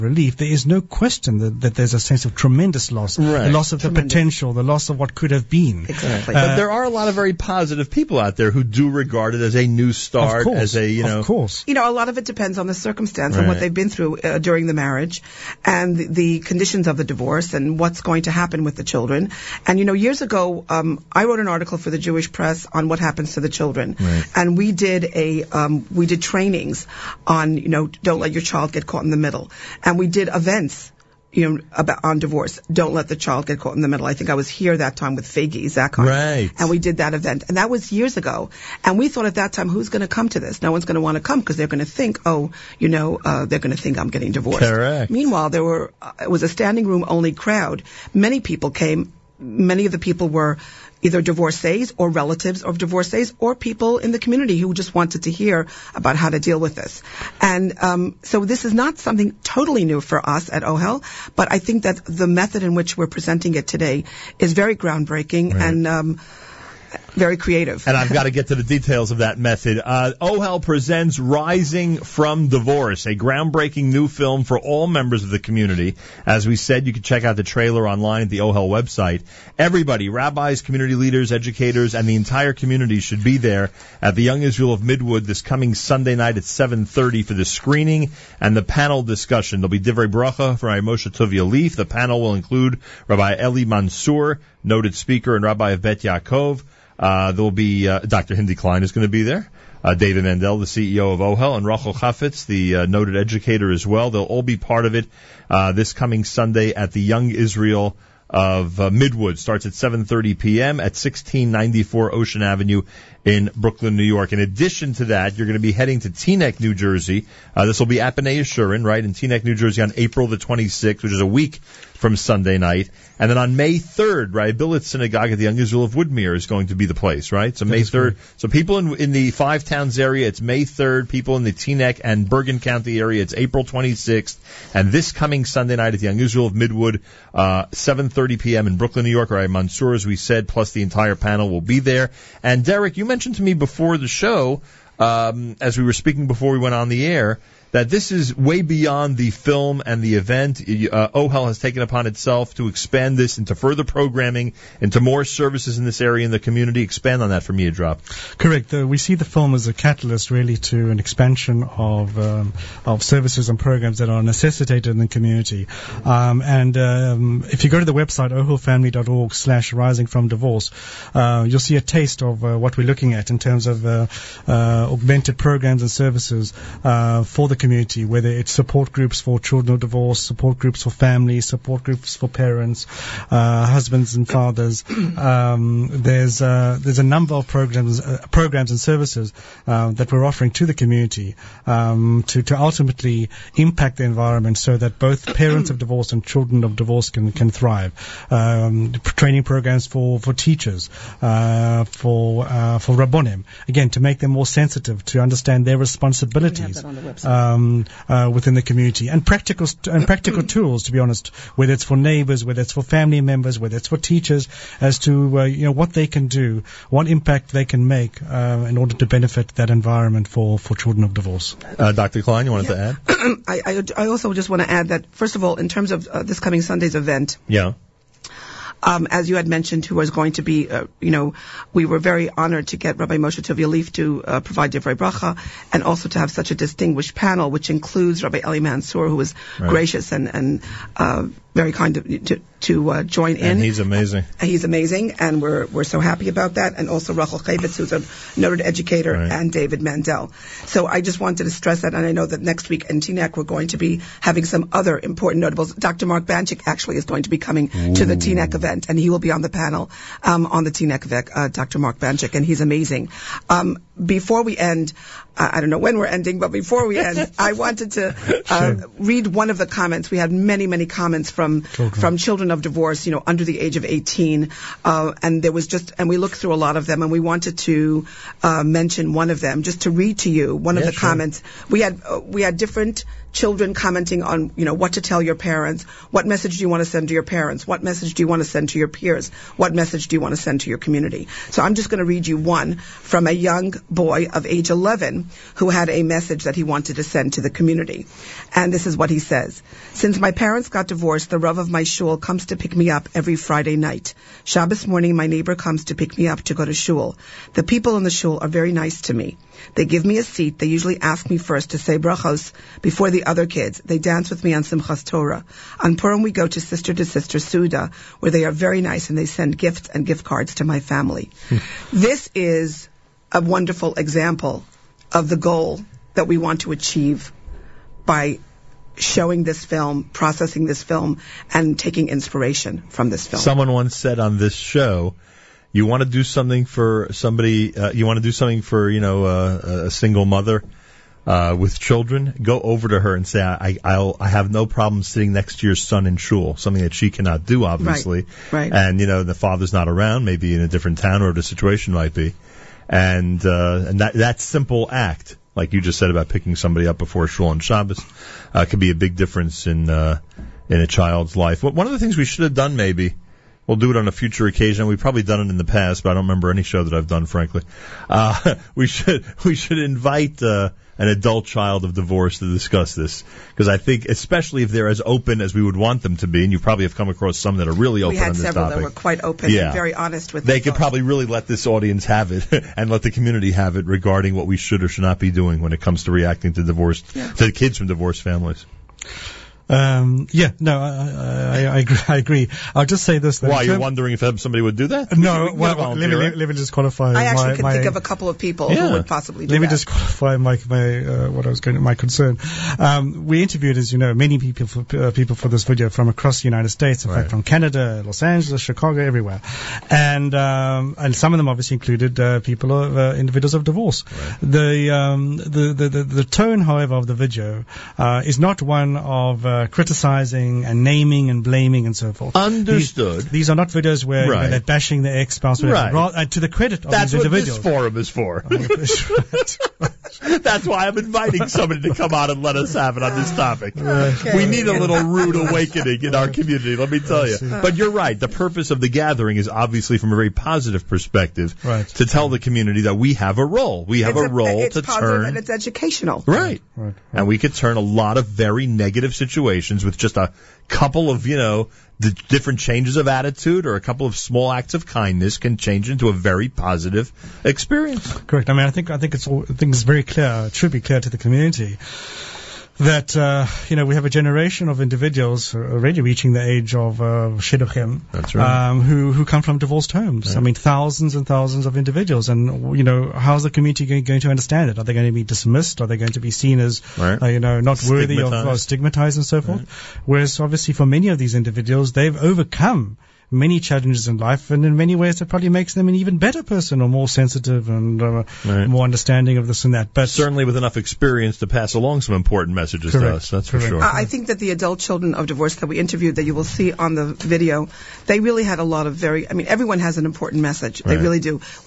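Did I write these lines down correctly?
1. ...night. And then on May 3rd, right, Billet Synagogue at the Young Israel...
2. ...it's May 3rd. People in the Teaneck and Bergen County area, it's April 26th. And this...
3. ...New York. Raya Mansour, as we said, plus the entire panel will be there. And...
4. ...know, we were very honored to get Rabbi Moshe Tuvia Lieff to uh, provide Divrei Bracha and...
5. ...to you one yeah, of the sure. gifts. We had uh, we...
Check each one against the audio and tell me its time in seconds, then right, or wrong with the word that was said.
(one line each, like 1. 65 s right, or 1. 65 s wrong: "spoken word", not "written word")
1. 122 s right
2. 130 s right
3. 139 s right
4. 231 s right
5. 280 s wrong: "comments", not "gifts".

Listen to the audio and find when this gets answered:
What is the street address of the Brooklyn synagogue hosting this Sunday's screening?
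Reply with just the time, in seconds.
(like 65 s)
110 s.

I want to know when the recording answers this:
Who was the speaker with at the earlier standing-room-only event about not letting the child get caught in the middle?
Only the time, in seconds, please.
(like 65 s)
35 s.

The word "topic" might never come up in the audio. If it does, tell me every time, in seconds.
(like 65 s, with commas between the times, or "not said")
378 s, 433 s.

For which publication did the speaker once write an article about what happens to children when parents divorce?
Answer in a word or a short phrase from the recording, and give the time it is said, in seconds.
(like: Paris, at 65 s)
The Jewish Press, at 21 s.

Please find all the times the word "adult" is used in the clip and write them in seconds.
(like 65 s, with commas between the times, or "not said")
371 s, 494 s.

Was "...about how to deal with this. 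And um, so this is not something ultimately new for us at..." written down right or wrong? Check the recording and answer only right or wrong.
wrong.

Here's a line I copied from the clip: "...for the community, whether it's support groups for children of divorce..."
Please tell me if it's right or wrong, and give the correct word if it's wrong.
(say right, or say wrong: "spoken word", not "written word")
right.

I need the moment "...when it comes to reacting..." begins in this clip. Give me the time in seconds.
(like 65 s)
385 s.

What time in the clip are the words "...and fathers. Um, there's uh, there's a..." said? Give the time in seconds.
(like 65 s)
184 s.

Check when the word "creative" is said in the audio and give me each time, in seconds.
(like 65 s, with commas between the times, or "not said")
67 s.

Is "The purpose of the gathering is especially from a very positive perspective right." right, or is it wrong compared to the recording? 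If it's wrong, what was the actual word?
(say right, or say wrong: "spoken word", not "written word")
wrong: "obviously", not "especially".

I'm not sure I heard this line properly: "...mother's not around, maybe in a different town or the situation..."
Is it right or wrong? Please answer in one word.
wrong.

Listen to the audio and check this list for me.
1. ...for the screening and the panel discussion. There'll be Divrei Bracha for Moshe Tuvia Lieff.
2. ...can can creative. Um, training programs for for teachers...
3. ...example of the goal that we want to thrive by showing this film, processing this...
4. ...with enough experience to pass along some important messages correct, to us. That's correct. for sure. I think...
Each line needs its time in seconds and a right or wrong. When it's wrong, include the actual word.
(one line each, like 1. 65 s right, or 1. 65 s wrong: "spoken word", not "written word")
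1. 87 s right
2. 197 s wrong: "thrive", not "creative"
3. 323 s wrong: "achieve", not "thrive"
4. 490 s right.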